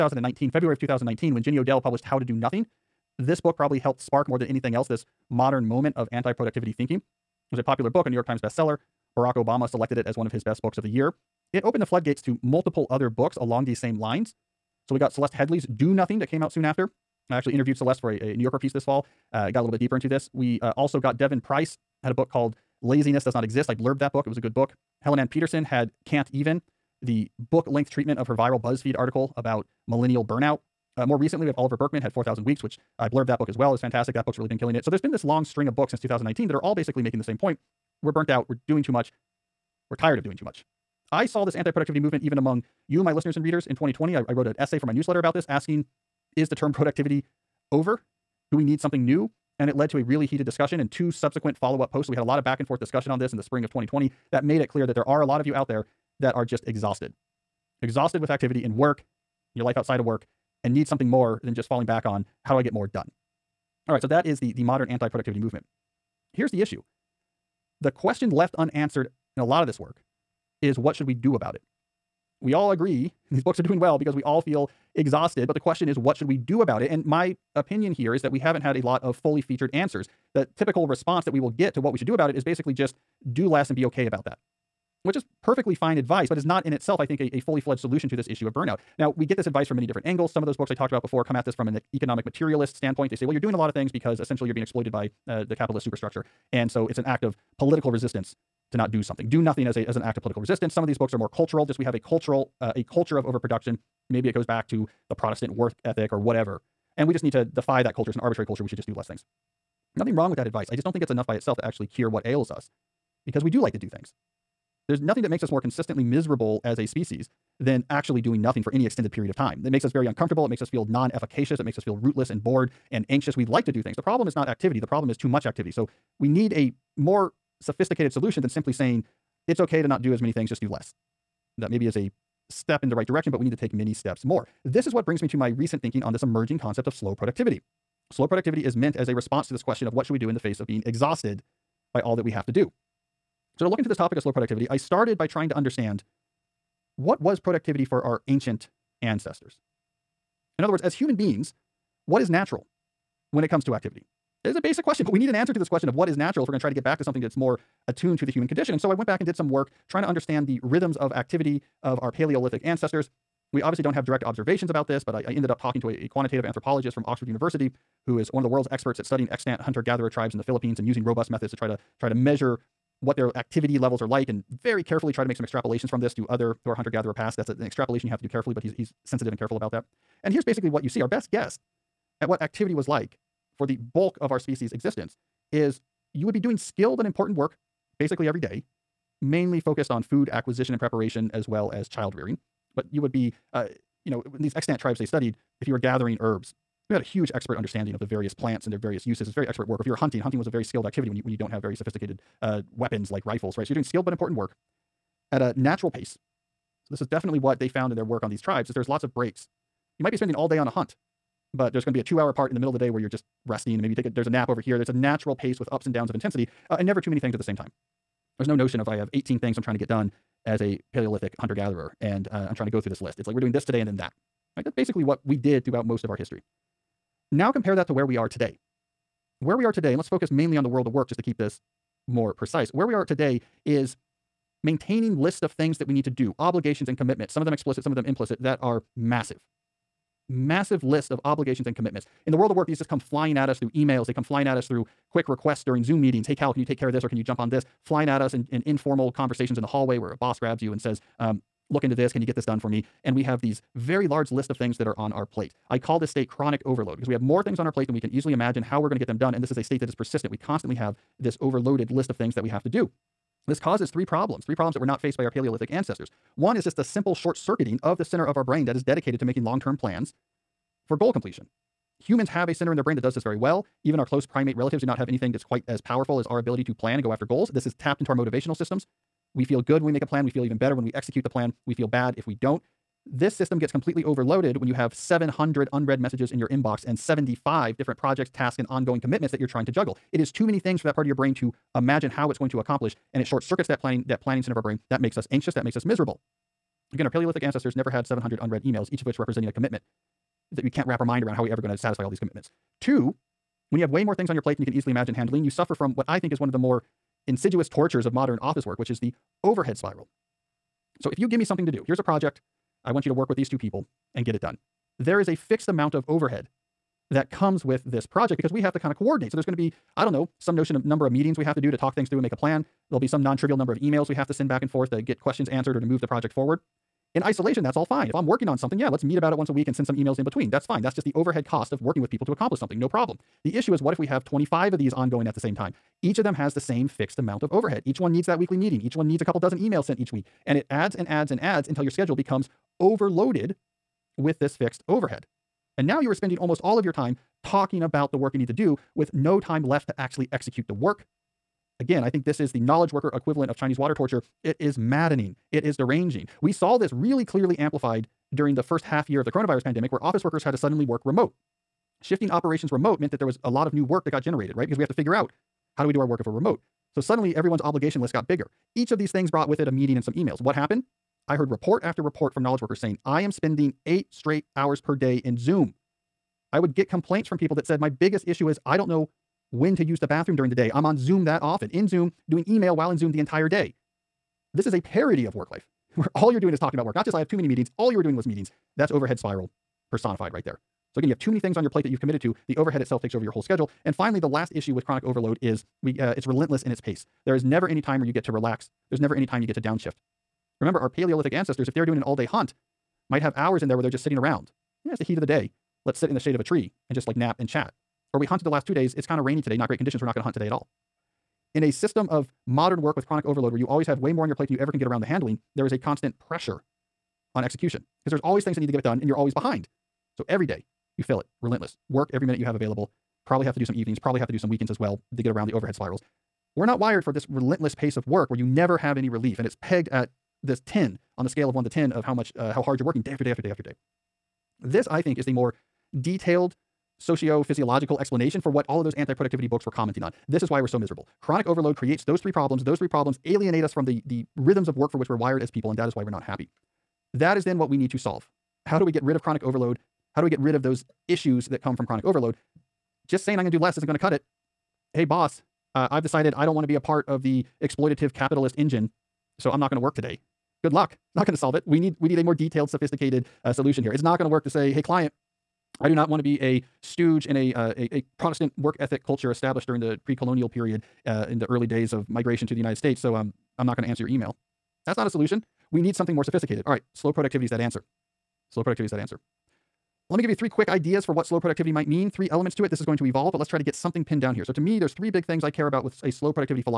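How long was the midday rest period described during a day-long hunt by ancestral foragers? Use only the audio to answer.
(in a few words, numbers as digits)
2 hours.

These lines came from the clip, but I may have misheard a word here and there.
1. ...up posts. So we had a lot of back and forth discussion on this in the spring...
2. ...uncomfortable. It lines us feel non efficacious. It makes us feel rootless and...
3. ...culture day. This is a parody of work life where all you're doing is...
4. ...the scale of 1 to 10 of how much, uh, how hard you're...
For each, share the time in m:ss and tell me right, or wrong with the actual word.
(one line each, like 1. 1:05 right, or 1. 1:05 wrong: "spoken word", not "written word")
1. 0:51 right
2. 2:00 wrong: "makes", not "lines"
3. 6:23 wrong: "entire", not "culture"
4. 7:11 right.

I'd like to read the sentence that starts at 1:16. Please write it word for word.
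And my opinion here is that we haven't had a lot of fully featured answers.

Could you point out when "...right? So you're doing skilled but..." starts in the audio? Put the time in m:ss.
3:23.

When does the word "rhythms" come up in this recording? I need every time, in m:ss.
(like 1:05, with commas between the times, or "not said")
2:40, 7:24.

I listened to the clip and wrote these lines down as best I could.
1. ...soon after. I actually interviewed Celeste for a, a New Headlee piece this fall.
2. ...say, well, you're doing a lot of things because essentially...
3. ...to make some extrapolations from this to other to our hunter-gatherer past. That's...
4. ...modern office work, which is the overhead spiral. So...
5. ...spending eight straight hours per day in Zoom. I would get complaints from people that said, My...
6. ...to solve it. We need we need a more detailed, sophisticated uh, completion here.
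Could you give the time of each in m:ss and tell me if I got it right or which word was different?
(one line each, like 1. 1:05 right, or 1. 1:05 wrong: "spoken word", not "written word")
1. 0:16 wrong: "Yorker", not "Headlee"
2. 1:33 right
3. 2:55 right
4. 5:08 right
5. 6:13 right
6. 7:41 wrong: "solution", not "completion".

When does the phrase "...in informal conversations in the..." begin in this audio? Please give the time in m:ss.
4:08.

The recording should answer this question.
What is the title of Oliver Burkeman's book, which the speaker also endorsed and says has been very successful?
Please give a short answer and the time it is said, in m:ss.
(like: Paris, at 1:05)
4,000 Weeks, at 0:32.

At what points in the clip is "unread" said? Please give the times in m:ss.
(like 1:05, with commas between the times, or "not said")
4:45, 4:58.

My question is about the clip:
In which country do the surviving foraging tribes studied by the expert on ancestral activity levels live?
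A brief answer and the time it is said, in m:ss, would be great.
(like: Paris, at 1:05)
the Philippines, at 2:50.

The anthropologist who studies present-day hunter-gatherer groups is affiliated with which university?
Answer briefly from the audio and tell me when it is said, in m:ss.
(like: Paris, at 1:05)
Oxford University, at 2:47.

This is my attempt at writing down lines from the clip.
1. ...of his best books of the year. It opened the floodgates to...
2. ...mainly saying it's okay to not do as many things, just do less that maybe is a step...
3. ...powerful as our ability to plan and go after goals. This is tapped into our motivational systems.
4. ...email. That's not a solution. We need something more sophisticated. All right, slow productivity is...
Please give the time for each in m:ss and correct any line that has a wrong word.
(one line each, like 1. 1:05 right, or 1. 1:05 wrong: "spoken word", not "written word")
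1. 0:10 right
2. 2:08 wrong: "simply", not "mainly"
3. 4:35 right
4. 7:54 right.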